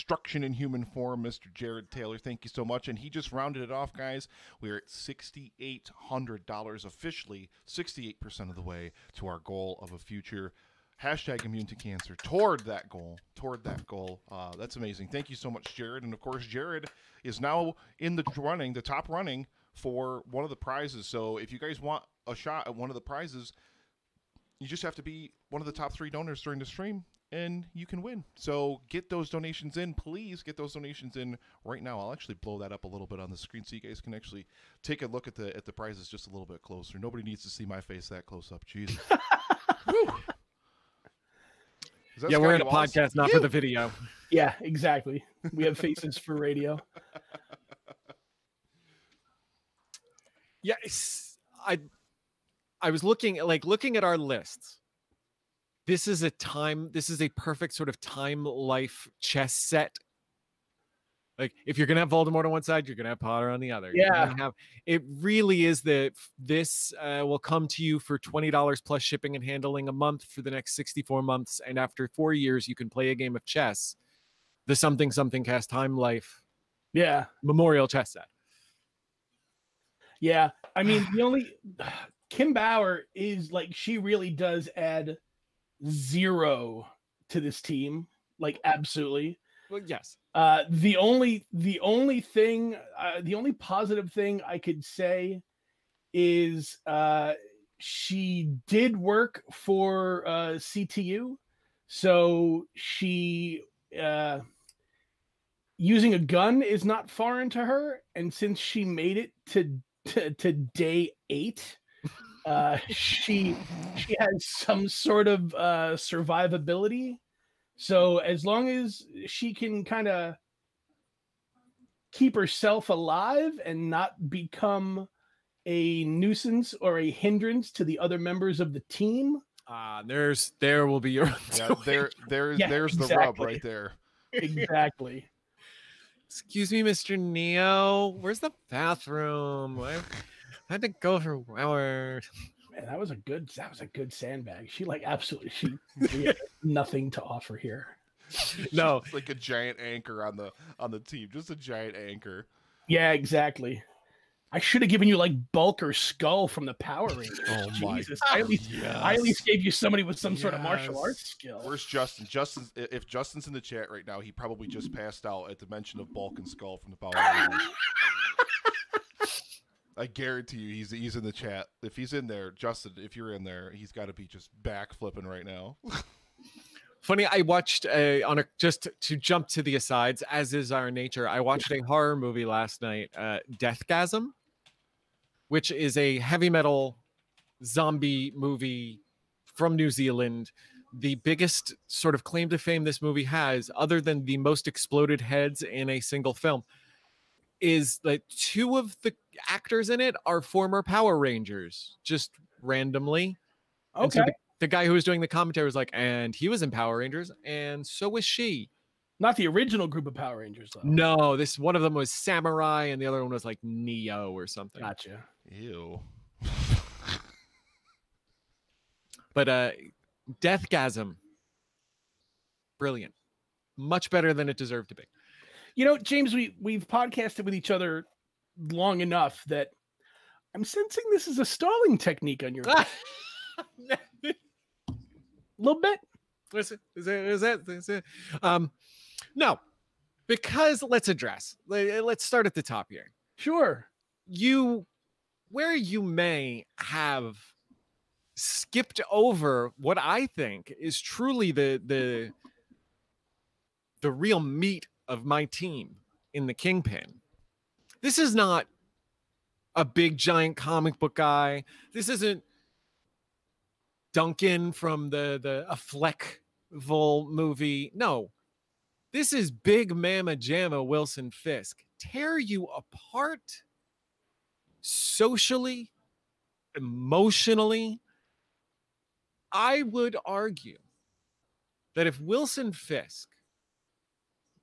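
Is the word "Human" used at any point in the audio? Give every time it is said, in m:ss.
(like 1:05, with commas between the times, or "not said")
0:00.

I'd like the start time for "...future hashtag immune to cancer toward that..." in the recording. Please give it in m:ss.
0:09.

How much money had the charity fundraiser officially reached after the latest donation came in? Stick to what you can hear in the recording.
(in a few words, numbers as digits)
$6,800.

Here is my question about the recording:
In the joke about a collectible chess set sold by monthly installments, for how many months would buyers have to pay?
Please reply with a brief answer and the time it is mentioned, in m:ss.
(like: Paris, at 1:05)
64, at 1:10.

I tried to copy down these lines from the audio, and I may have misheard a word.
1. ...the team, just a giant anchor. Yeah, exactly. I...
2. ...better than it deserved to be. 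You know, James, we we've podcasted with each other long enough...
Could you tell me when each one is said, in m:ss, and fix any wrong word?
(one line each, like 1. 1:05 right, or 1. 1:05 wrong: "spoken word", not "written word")
1. 2:30 right
2. 3:44 right.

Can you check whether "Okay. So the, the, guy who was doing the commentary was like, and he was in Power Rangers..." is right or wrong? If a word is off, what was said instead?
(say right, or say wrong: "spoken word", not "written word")
right.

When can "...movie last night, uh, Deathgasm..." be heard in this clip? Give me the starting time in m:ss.
3:02.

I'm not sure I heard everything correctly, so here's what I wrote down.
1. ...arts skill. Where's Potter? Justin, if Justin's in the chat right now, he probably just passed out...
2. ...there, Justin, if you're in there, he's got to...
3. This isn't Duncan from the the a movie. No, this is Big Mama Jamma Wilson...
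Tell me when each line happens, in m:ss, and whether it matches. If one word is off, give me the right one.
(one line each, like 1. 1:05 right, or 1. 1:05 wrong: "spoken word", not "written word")
1. 2:41 wrong: "Justin", not "Potter"
2. 2:52 right
3. 4:21 right.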